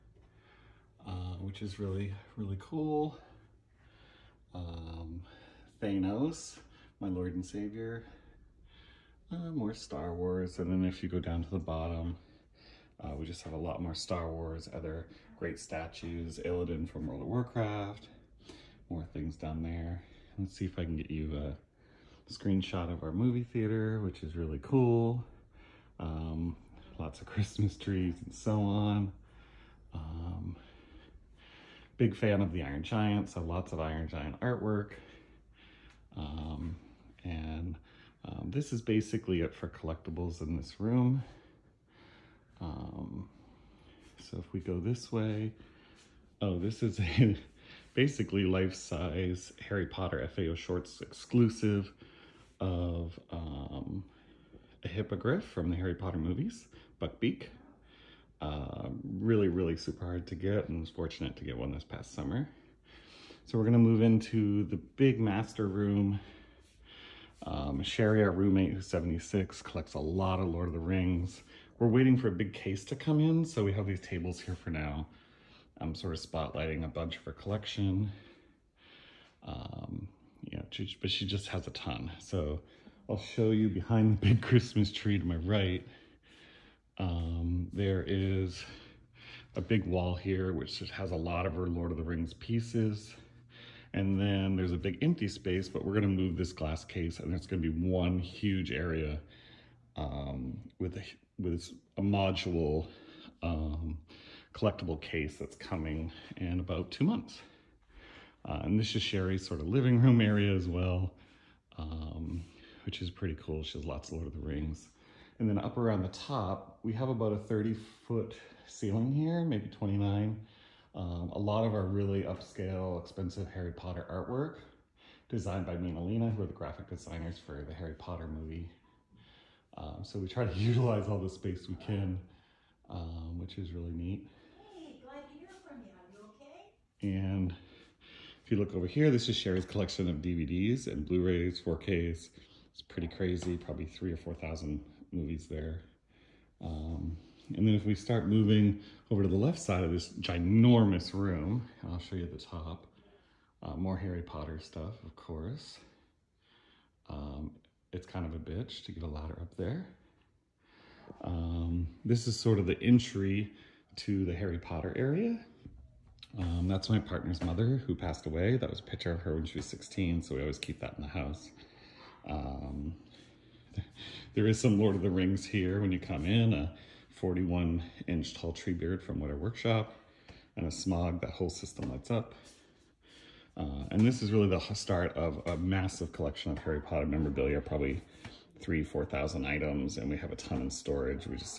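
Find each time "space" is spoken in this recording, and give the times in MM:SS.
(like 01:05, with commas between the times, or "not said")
01:35, 02:11.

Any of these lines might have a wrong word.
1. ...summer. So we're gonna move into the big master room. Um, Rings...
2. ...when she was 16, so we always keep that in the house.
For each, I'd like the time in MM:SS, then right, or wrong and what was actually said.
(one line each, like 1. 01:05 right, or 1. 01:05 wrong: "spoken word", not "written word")
1. 01:02 wrong: "Sherry", not "Rings"
2. 02:49 right.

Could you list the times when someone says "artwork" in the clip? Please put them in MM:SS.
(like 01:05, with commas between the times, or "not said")
00:34, 02:04.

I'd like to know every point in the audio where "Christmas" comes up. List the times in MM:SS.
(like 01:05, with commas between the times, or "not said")
00:27, 01:24.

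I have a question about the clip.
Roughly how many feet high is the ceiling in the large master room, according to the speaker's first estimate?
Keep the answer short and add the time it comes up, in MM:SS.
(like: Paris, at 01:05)
30, at 01:57.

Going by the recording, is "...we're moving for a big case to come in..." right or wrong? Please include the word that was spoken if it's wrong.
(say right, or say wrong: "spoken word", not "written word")
wrong: "waiting", not "moving".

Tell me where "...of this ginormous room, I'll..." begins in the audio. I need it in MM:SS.
02:29.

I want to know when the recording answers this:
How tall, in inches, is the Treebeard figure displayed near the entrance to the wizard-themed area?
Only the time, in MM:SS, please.
02:57.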